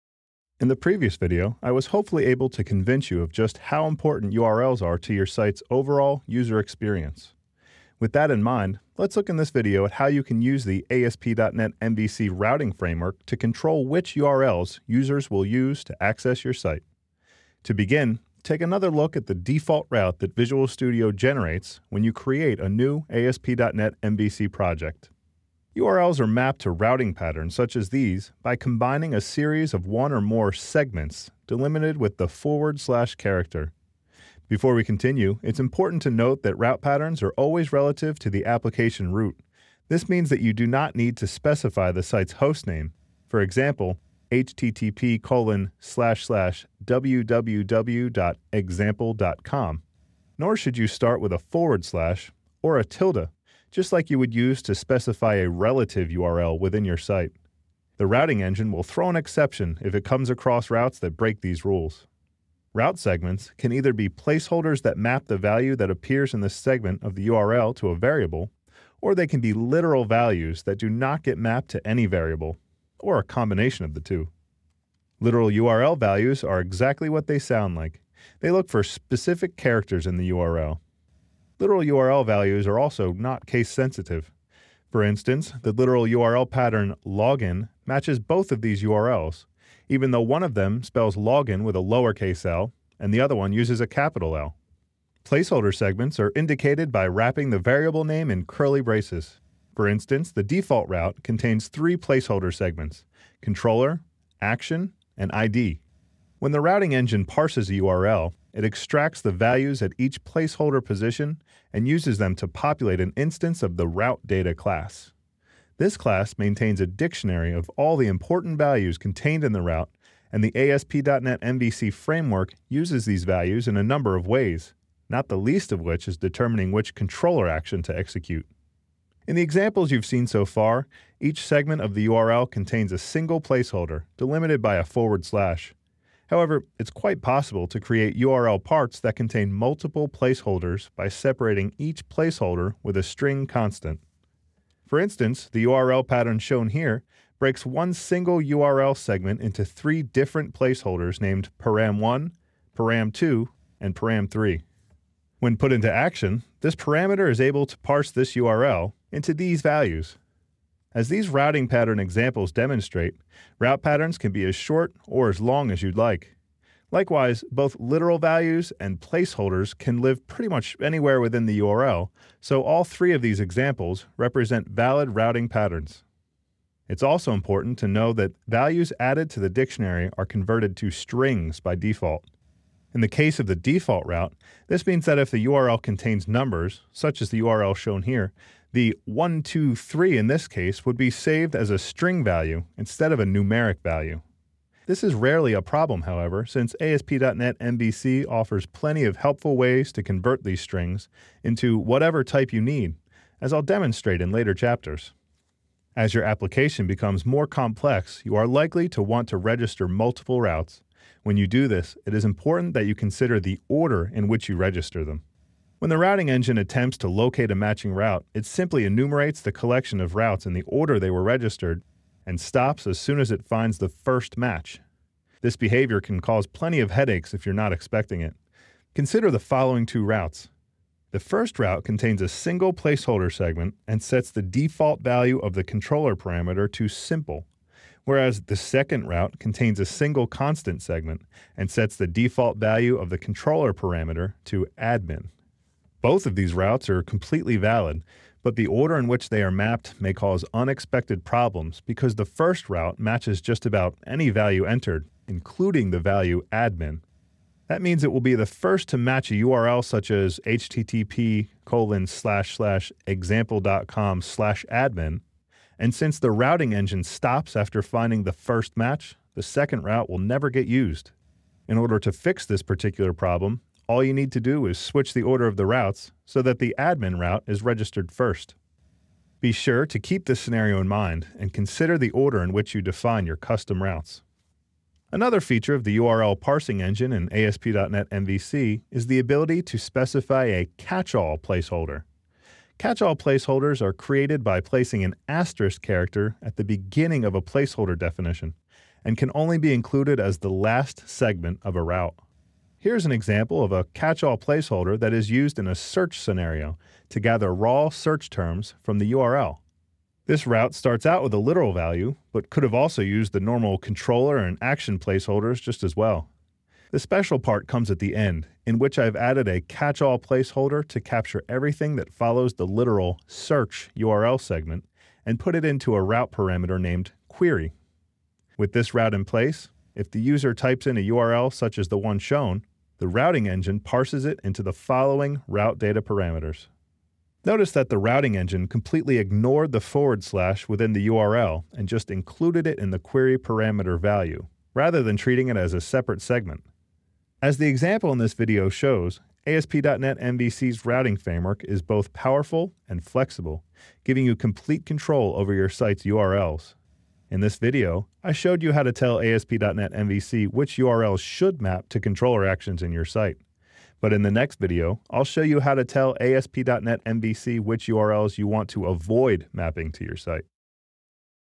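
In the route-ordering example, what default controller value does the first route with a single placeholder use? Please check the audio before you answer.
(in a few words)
simple.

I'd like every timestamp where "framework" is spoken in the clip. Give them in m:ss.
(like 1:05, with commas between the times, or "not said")
0:12, 2:01, 5:51.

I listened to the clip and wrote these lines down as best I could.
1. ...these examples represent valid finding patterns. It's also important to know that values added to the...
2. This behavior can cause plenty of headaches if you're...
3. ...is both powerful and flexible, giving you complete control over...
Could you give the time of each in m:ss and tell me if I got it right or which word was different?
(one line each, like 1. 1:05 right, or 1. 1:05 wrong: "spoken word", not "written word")
1. 2:53 wrong: "routing", not "finding"
2. 3:45 right
3. 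5:51 right.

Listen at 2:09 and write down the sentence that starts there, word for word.
In the examples you've seen so far, each segment of the URL contains a single placeholder, delimited by a forward slash.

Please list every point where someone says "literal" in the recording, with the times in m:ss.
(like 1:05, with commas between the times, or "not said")
1:09, 1:15, 1:21, 1:25, 2:47, 5:11, 5:22.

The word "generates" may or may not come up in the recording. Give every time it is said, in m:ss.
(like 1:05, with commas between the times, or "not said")
0:21.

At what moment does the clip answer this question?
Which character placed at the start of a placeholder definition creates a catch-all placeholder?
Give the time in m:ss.
4:55.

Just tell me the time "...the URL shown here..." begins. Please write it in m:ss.
3:07.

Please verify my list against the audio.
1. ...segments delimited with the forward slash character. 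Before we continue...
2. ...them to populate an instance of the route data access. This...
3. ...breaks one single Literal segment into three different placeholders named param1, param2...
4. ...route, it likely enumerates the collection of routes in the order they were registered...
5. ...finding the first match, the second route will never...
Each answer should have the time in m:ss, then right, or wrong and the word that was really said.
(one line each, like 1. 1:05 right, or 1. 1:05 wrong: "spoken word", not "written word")
1. 0:30 right
2. 1:52 wrong: "class", not "access"
3. 2:27 wrong: "URL", not "Literal"
4. 3:37 wrong: "simply", not "likely"
5. 4:27 right.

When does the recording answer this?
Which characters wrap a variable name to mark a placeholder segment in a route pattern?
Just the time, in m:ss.
1:38.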